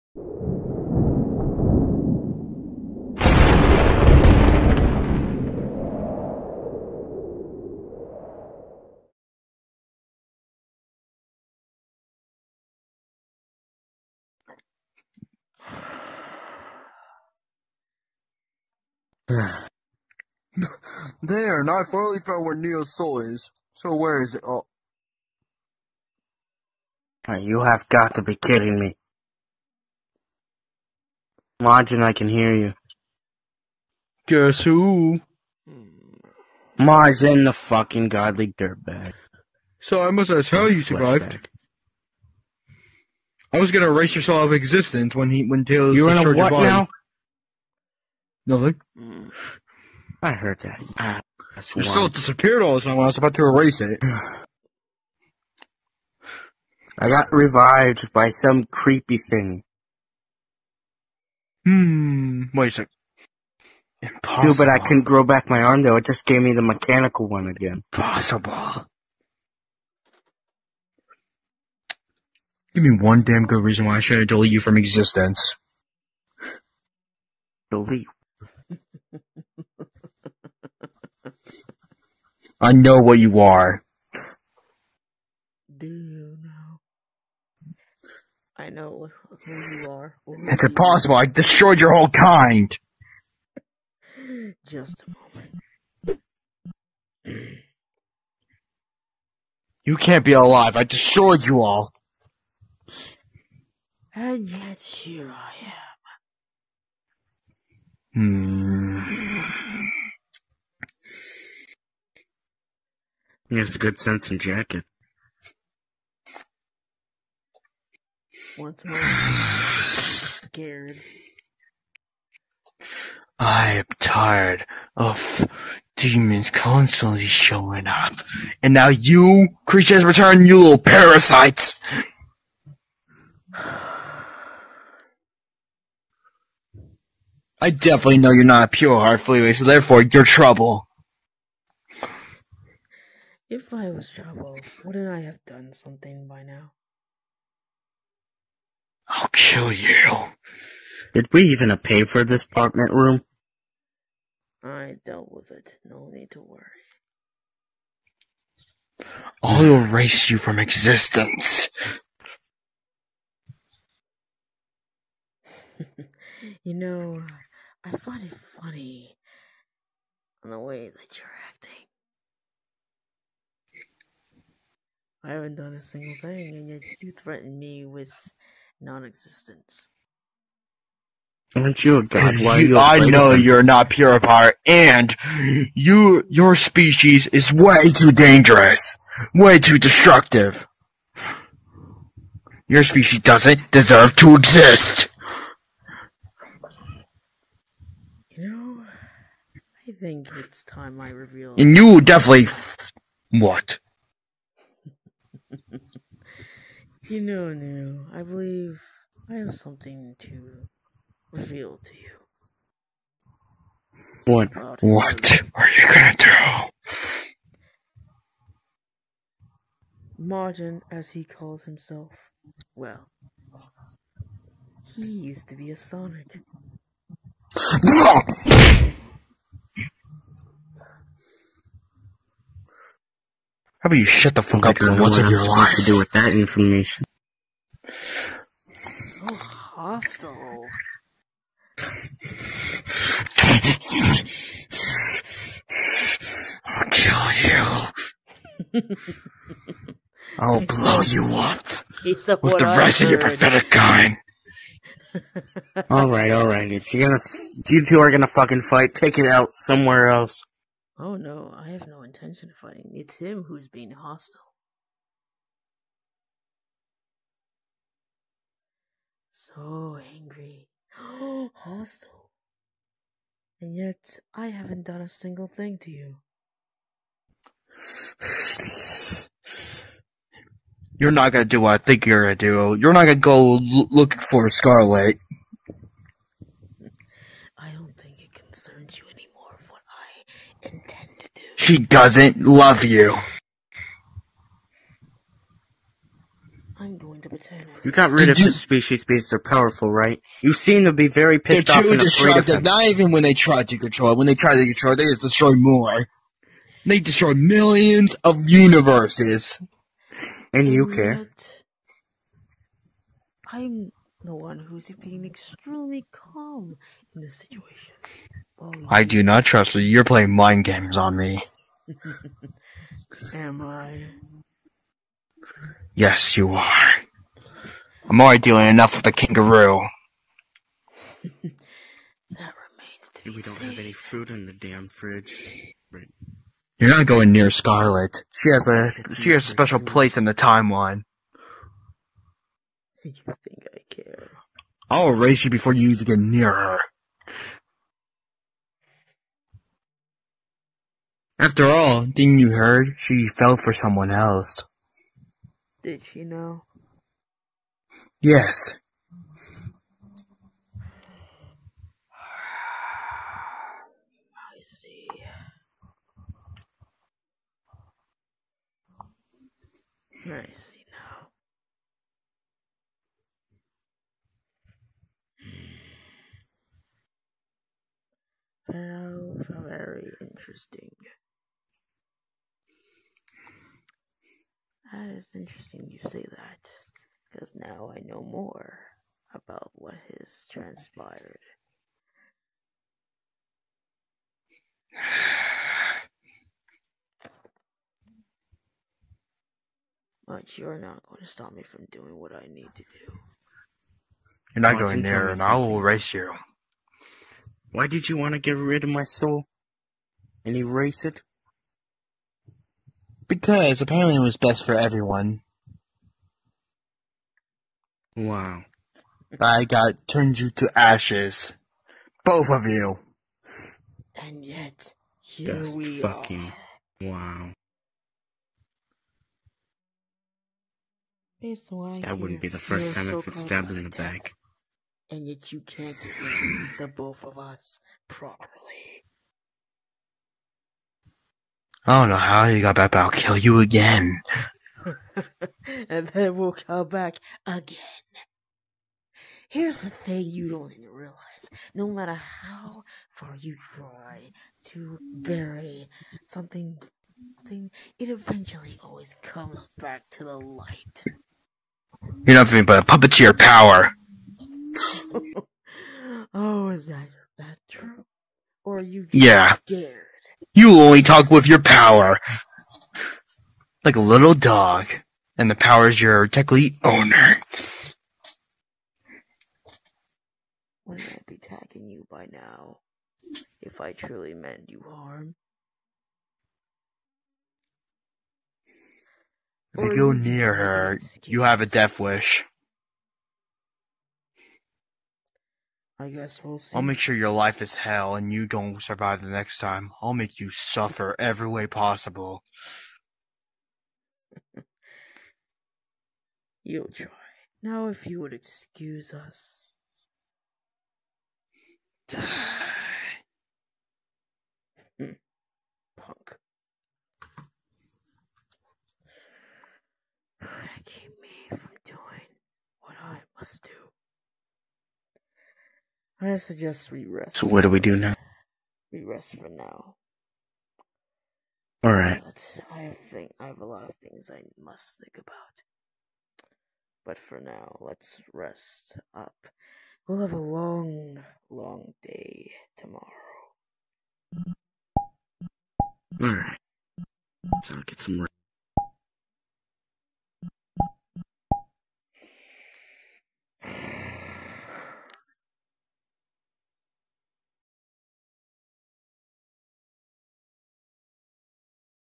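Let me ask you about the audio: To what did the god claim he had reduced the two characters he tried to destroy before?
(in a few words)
ashes.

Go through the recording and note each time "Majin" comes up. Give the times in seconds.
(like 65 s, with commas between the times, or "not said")
31 s, 36 s.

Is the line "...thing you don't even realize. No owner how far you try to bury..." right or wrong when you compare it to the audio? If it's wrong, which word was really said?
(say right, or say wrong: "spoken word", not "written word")
wrong: "matter", not "owner".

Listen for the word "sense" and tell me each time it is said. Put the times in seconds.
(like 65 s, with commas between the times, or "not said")
113 s.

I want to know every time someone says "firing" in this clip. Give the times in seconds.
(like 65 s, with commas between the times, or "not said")
not said.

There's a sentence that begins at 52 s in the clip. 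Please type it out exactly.
I was about to erase it.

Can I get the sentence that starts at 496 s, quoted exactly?
I'll make sure your life is hell and you don't survive the next time.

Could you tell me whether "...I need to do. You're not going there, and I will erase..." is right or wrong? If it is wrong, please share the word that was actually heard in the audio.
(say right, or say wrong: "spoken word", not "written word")
right.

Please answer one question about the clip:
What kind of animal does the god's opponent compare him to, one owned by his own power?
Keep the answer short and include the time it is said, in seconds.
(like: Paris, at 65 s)
little dog, at 474 s.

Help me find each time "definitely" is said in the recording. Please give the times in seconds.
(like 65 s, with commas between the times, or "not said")
137 s, 202 s.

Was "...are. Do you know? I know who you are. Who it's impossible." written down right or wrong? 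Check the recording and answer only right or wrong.
right.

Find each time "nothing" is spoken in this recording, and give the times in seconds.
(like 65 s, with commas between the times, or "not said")
48 s, 462 s.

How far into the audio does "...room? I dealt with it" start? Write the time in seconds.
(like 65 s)
152 s.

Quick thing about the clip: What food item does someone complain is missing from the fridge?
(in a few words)
fruit.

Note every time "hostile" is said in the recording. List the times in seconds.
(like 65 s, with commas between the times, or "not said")
239 s, 263 s, 271 s.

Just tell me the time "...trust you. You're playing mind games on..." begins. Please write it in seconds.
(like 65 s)
319 s.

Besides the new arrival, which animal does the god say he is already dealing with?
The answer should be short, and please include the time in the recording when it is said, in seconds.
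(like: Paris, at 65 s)
kangaroo, at 329 s.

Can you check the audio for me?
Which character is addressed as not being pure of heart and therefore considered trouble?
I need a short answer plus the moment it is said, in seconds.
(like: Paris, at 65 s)
Fleetway, at 139 s.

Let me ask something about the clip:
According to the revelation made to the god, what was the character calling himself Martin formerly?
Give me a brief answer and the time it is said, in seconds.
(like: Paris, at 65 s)
a Sonic, at 225 s.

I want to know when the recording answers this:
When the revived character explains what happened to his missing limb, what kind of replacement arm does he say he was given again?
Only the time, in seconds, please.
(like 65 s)
66 s.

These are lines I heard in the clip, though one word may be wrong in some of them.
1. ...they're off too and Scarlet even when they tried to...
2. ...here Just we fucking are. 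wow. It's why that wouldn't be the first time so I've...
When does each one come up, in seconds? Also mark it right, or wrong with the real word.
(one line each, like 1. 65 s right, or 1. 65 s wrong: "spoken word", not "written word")
1. 301 s wrong: "Not", not "Scarlet"
2. 425 s right.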